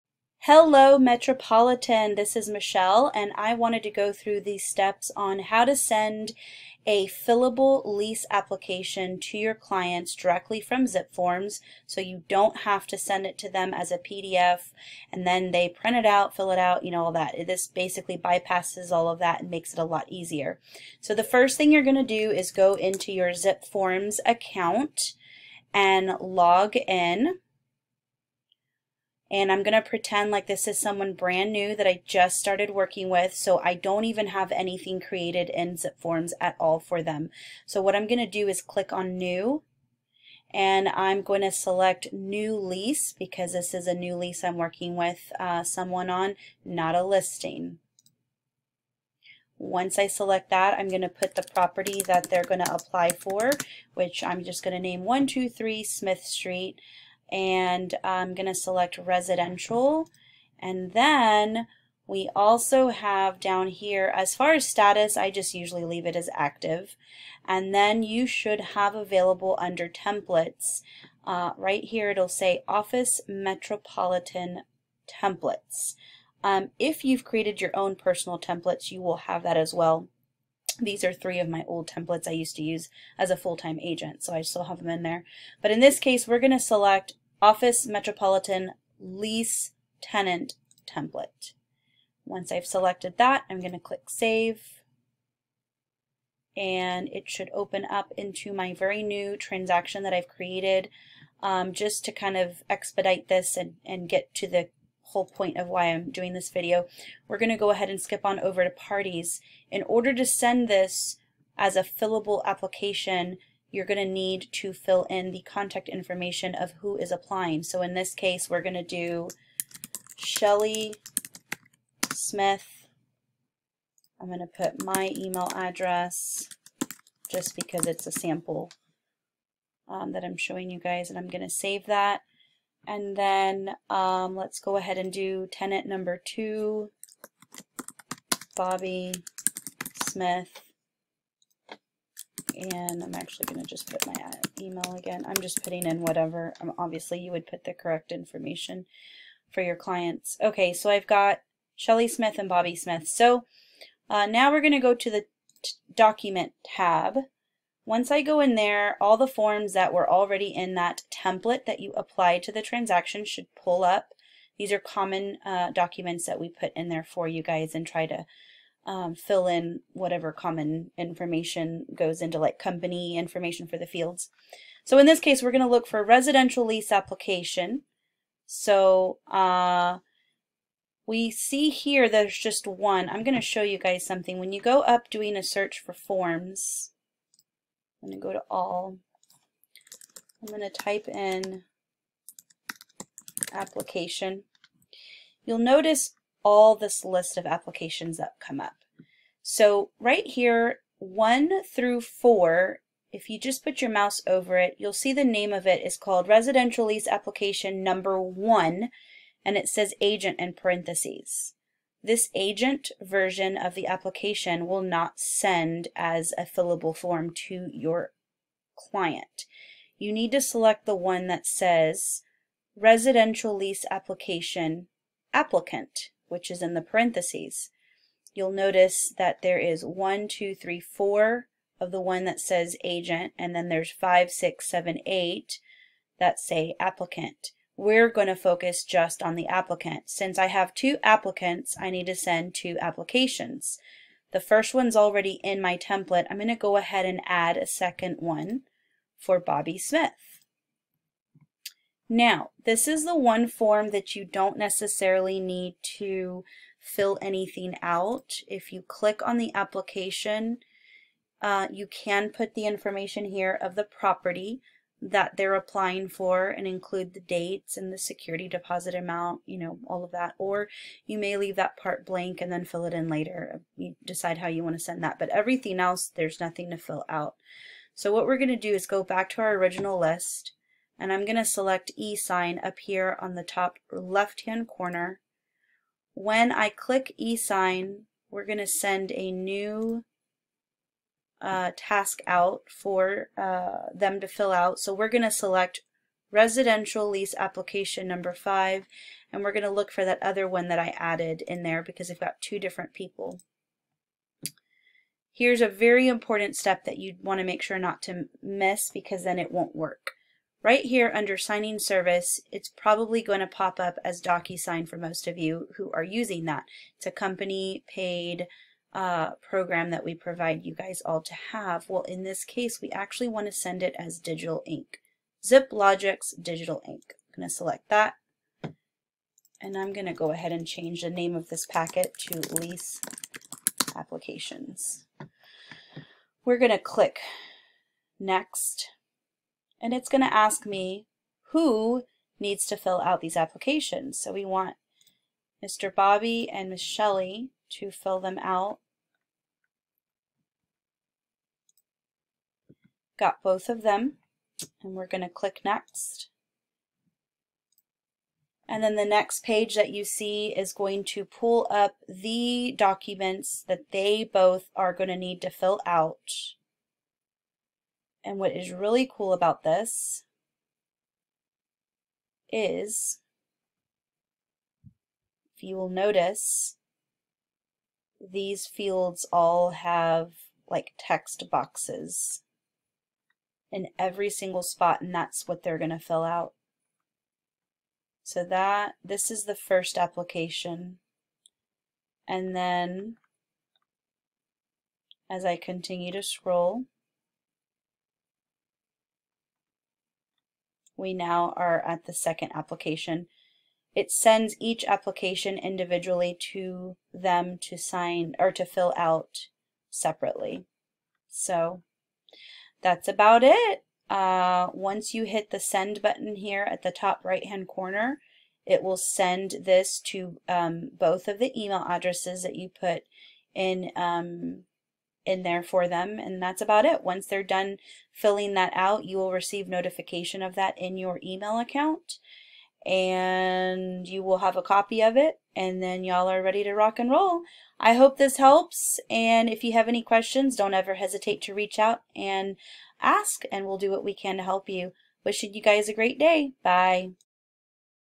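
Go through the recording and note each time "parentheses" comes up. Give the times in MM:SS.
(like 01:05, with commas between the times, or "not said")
03:30, 03:46.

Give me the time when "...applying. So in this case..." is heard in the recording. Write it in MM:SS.
01:57.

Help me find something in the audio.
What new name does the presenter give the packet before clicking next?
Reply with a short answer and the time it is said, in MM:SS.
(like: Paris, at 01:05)
lease applications, at 05:32.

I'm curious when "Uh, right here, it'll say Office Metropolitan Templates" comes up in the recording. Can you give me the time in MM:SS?
01:11.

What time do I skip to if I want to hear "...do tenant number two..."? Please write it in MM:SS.
02:15.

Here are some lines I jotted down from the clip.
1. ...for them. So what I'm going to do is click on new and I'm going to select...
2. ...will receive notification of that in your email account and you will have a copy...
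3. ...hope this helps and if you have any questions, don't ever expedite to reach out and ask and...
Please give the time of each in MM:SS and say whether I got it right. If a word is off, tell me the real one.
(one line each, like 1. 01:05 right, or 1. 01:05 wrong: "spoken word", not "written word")
1. 00:36 right
2. 07:09 right
3. 07:17 wrong: "hesitate", not "expedite".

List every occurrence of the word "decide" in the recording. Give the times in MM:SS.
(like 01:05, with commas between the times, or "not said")
04:34.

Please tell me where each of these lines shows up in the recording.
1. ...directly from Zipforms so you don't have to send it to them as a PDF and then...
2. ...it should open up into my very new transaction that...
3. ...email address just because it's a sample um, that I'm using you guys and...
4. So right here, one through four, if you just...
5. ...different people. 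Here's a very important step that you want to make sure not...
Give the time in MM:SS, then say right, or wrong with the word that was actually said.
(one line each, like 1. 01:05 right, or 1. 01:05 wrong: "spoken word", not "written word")
1. 00:10 right
2. 01:37 right
3. 02:05 wrong: "showing", not "using"
4. 03:19 right
5. 05:02 right.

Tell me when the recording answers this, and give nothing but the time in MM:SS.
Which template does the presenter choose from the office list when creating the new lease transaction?
01:27.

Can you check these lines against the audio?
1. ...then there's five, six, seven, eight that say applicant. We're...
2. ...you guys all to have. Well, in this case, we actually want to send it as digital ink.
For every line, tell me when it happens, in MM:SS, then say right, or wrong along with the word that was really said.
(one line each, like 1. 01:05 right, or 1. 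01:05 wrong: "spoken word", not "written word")
1. 03:53 right
2. 05:20 right.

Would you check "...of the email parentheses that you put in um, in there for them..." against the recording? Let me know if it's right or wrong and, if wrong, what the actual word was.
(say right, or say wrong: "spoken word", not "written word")
wrong: "addresses", not "parentheses".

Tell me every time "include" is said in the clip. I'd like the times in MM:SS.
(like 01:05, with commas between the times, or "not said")
04:26.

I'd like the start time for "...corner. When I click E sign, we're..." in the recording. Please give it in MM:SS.
04:44.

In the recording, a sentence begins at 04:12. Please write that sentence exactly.
Now, this is the one form that you don't necessarily need to fill anything out.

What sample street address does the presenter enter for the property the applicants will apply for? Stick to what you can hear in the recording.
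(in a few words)
123 Smith Street.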